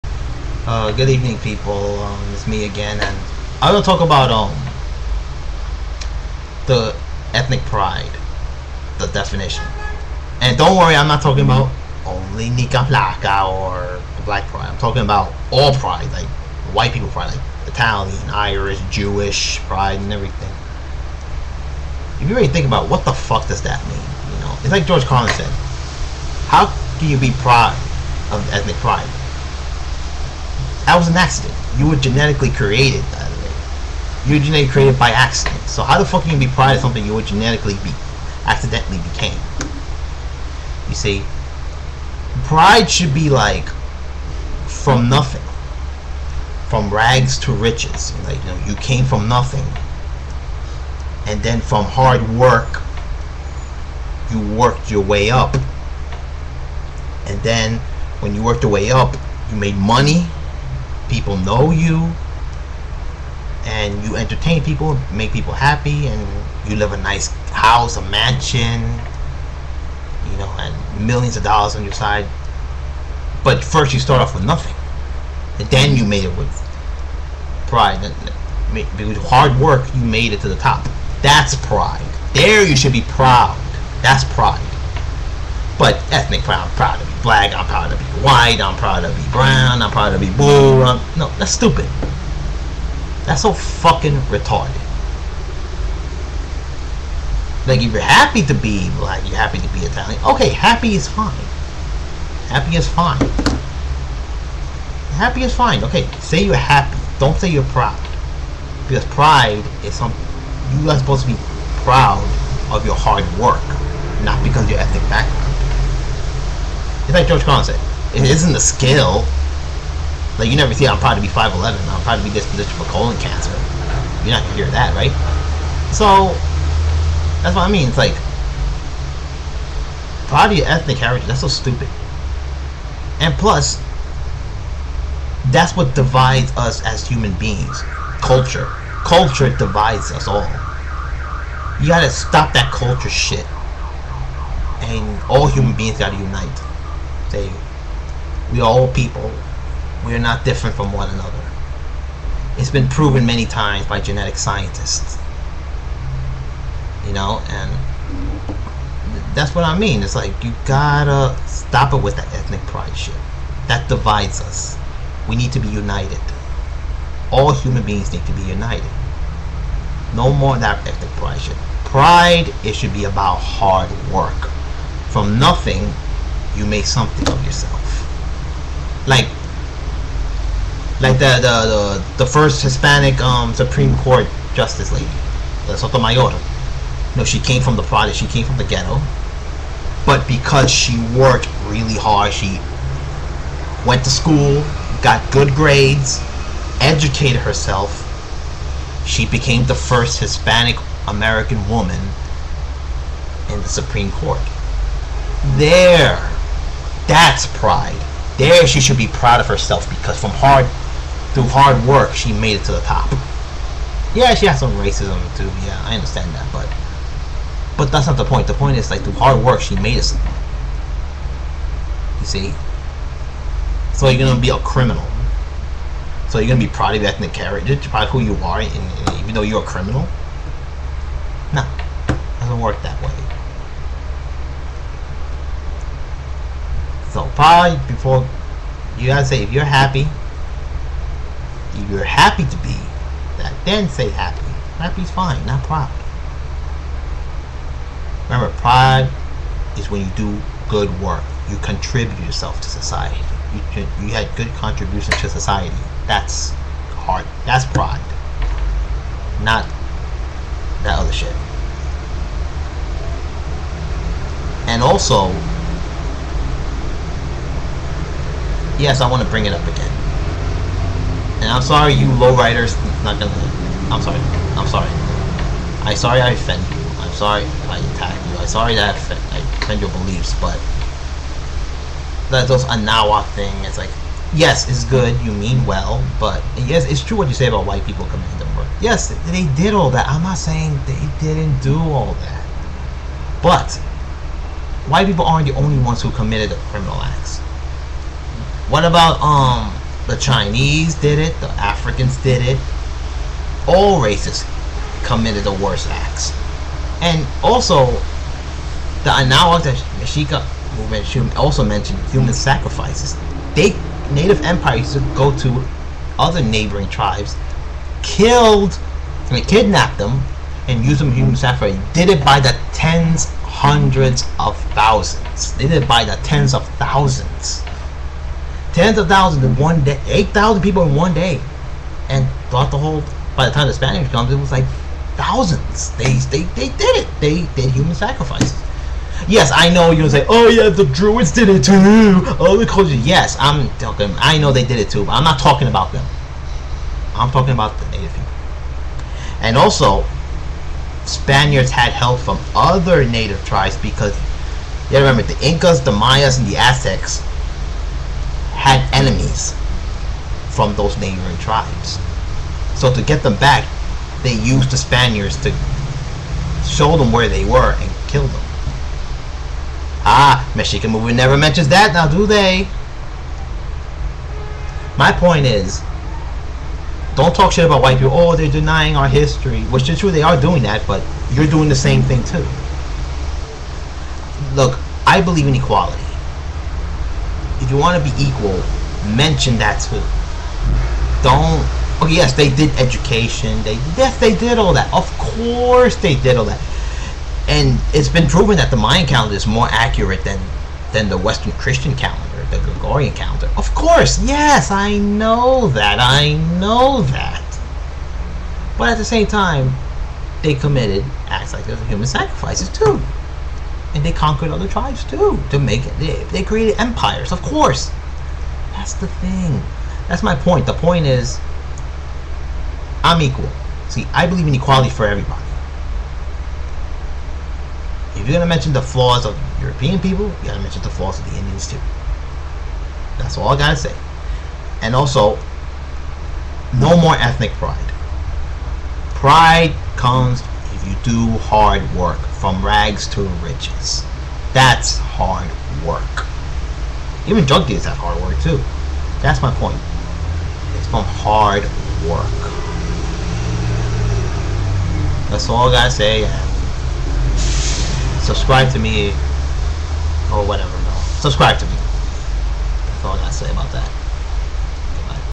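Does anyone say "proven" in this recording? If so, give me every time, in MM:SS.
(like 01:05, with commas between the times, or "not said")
02:32, 06:38.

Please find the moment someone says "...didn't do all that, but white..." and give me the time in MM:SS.
04:51.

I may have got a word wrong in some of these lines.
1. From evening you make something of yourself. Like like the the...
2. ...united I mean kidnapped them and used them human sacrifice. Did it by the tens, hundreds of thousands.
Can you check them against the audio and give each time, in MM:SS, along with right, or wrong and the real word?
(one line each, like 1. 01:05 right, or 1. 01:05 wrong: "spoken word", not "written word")
1. 02:55 wrong: "nothing", not "evening"
2. 05:18 wrong: "killed", not "united".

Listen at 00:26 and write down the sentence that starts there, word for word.
How can you be proud of ethnic pride?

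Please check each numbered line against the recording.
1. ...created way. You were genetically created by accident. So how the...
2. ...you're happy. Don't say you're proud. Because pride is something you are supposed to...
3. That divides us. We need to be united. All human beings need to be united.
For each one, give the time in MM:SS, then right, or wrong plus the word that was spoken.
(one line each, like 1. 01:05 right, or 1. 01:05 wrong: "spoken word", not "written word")
1. 00:32 right
2. 01:46 right
3. 02:43 right.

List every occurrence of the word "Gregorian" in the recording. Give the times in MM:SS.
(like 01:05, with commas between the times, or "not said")
06:42.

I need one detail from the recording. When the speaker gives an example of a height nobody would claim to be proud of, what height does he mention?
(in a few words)
5'11.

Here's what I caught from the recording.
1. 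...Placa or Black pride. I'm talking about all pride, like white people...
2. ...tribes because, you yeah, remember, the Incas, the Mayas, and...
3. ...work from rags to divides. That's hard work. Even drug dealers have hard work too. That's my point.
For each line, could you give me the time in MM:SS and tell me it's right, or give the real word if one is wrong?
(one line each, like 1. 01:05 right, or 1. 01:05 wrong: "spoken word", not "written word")
1. 00:12 right
2. 05:53 right
3. 07:21 wrong: "riches", not "divides".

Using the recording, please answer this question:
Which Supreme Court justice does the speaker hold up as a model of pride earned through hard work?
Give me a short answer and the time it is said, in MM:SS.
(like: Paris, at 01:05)
Sotomayor, at 03:05.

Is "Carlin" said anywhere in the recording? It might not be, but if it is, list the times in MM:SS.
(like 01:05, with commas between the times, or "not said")
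00:25, 01:57.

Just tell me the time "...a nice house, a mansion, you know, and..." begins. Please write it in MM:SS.
01:06.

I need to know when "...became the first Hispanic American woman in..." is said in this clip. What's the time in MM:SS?
03:19.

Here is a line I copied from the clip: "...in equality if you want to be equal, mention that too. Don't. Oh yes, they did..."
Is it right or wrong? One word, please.
right.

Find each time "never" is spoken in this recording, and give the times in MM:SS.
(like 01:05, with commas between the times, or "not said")
02:00, 06:11.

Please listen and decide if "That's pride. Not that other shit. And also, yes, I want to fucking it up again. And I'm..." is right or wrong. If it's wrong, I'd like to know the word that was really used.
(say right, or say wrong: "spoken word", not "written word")
wrong: "bring", not "fucking".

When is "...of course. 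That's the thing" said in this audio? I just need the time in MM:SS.
06:57.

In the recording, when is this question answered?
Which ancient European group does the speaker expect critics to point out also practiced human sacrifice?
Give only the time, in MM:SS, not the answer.
05:40.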